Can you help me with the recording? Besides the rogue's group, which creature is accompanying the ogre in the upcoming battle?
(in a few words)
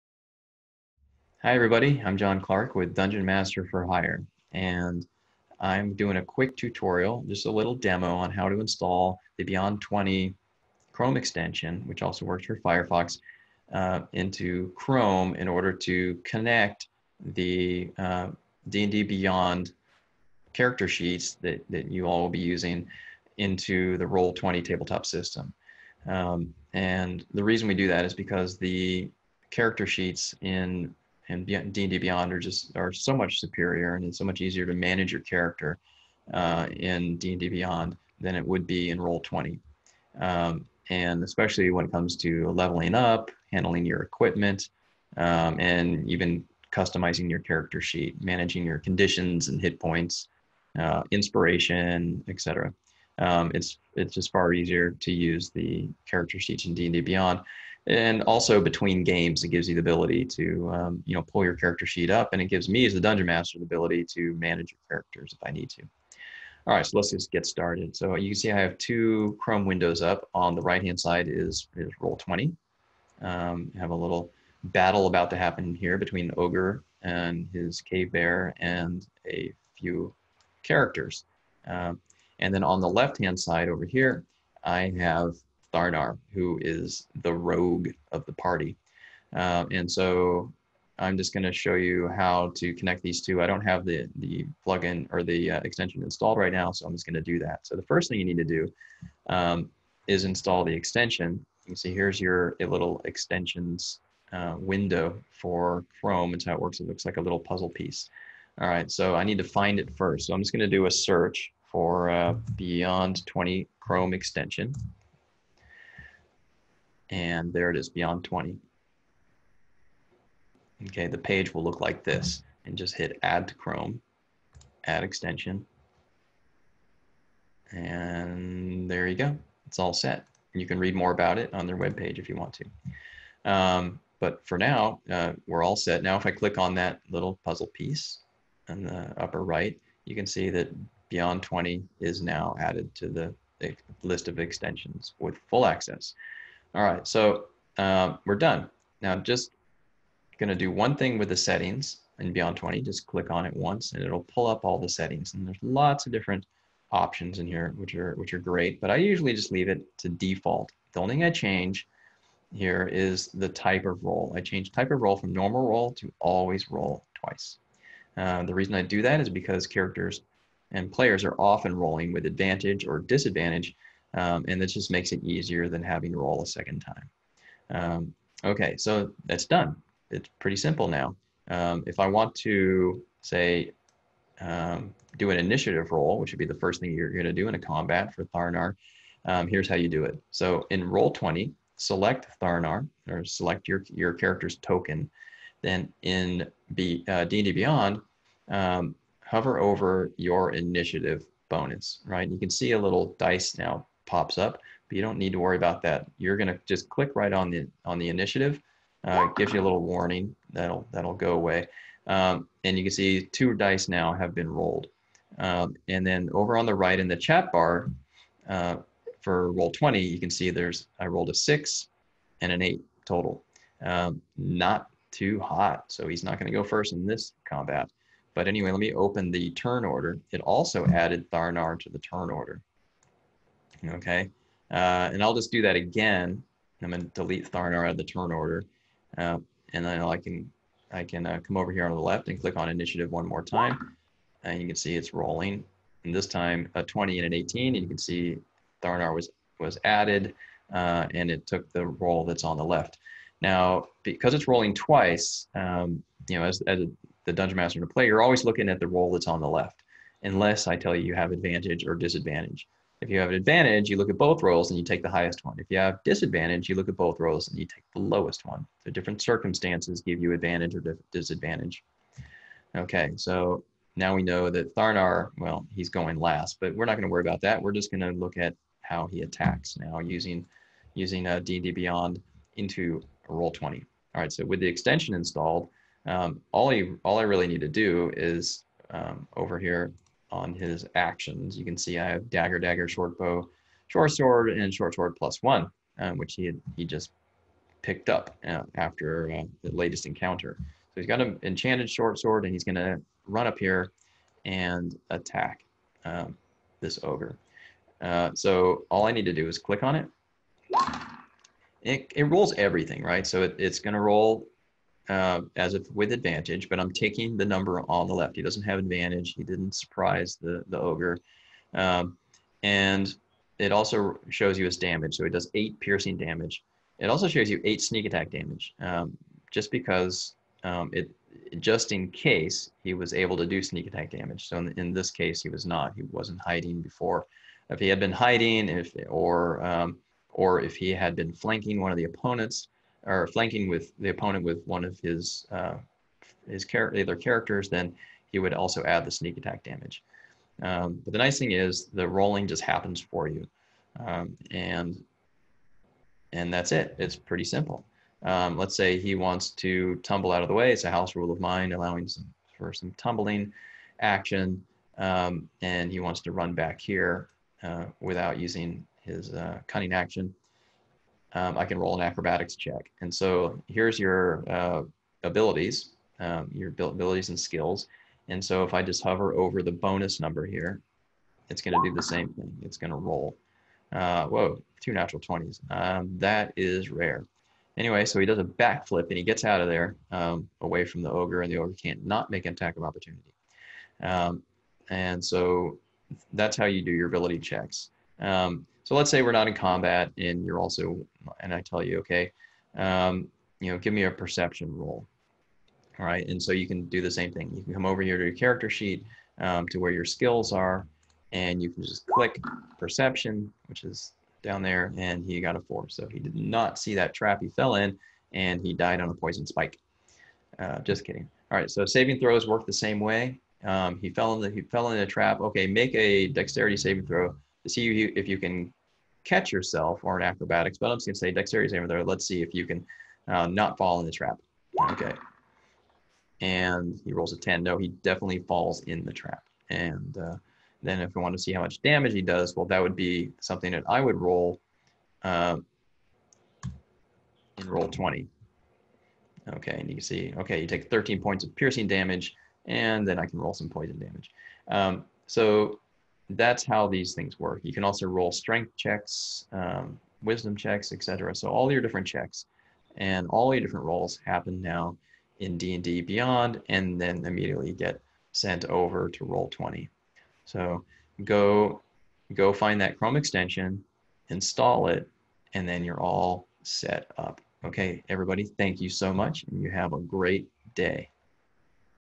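cave bear.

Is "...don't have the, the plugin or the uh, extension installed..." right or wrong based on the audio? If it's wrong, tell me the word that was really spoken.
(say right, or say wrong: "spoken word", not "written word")
right.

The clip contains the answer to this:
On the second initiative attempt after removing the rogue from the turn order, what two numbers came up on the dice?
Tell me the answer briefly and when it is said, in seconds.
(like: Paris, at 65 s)
20 and 18, at 246 s.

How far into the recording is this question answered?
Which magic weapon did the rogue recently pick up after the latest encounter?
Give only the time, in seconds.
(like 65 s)
294 s.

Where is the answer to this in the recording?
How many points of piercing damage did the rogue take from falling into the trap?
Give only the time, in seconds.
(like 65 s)
450 s.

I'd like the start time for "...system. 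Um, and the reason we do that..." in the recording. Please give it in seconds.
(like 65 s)
25 s.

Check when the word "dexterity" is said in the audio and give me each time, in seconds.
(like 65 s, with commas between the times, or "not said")
426 s, 431 s.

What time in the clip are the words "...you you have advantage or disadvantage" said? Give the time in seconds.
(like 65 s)
260 s.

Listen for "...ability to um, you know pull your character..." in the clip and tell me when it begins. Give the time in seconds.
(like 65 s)
59 s.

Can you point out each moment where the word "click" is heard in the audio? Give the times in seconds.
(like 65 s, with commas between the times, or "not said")
136 s, 153 s, 206 s, 242 s, 309 s, 412 s.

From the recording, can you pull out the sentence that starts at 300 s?
So he's got an enchanted short sword, and he's going to run up here and attack um, this ogre.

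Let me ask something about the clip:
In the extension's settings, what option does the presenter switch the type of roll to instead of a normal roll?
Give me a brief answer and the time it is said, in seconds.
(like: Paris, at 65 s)
always roll twice, at 166 s.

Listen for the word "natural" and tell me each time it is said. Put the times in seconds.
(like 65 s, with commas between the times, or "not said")
384 s.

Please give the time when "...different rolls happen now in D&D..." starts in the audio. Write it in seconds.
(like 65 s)
463 s.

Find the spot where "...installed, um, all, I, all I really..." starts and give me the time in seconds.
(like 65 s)
285 s.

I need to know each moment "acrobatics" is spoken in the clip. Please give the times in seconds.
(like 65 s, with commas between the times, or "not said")
372 s, 430 s.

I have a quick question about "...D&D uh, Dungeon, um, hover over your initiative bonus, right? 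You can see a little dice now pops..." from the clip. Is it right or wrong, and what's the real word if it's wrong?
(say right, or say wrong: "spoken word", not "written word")
wrong: "Beyond", not "Dungeon".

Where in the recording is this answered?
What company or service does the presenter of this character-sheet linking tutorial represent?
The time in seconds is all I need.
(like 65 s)
2 s.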